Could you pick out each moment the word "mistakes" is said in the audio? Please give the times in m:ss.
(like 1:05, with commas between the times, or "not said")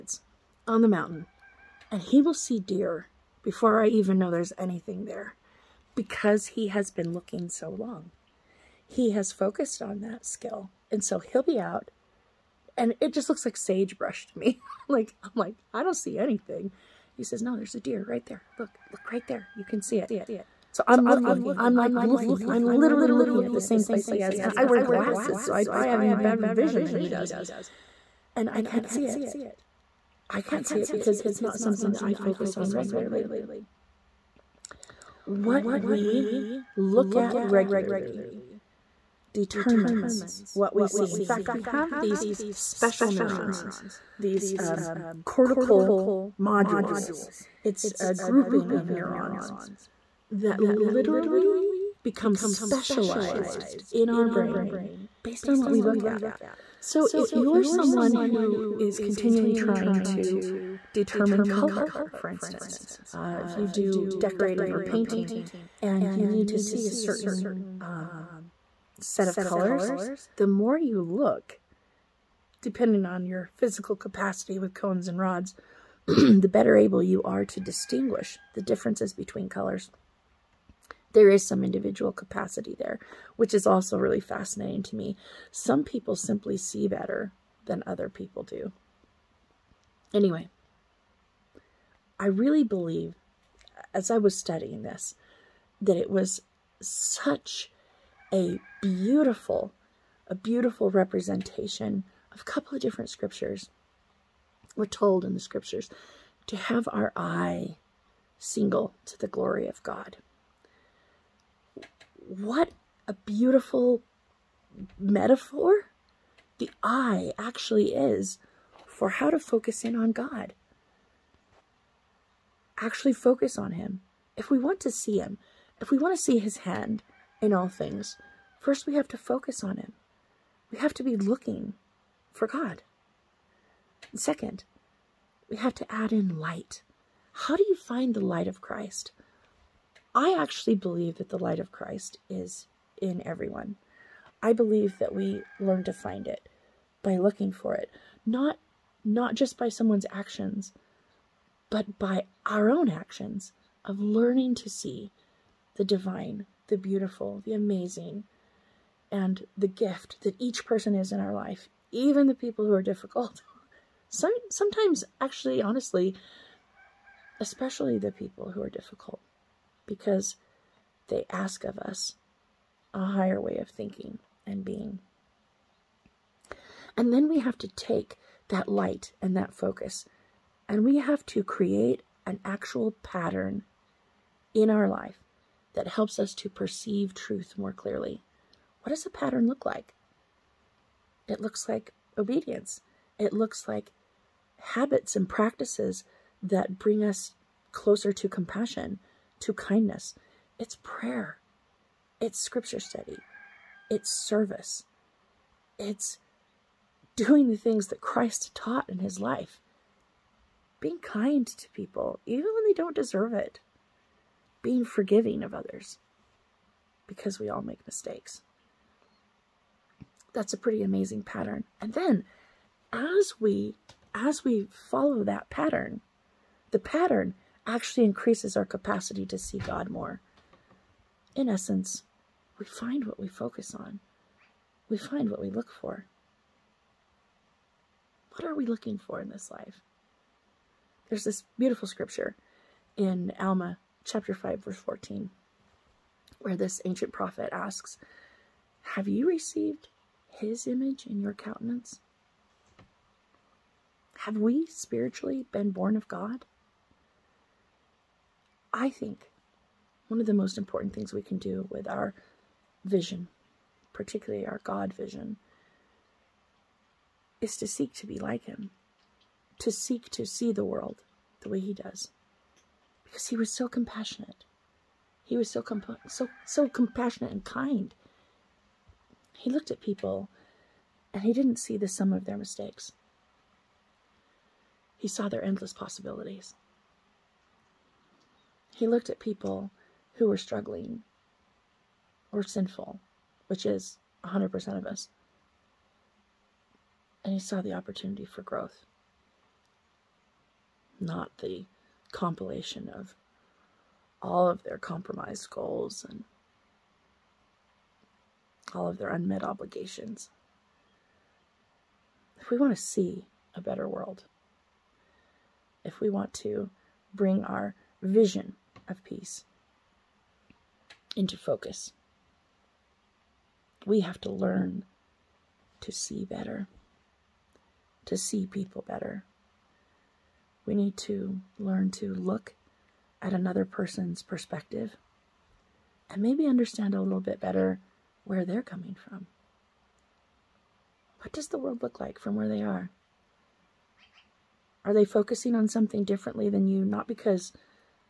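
3:37, 4:42.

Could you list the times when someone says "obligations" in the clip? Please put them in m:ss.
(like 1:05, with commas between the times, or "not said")
5:09.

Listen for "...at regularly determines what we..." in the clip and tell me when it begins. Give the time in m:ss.
0:37.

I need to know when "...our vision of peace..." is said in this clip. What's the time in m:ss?
5:17.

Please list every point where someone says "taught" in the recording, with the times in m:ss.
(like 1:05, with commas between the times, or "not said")
3:28.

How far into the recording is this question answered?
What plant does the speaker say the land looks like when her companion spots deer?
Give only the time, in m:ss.
0:13.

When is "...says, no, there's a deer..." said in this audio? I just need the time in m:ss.
0:17.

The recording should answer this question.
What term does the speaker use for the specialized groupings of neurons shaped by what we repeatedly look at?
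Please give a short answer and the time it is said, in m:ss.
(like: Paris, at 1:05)
Cortical modules, at 0:45.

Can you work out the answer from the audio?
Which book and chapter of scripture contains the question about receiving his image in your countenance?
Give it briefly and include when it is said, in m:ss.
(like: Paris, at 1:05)
Alma chapter 5, at 4:03.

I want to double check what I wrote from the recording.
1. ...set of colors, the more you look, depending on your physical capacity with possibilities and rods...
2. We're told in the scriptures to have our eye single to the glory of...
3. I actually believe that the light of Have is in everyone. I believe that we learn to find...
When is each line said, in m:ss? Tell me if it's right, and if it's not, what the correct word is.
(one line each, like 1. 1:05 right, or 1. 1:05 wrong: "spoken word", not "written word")
1. 1:08 wrong: "cones", not "possibilities"
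2. 1:44 right
3. 2:20 wrong: "Christ", not "Have".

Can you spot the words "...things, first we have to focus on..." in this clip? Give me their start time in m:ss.
2:07.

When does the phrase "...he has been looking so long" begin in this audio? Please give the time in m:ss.
0:06.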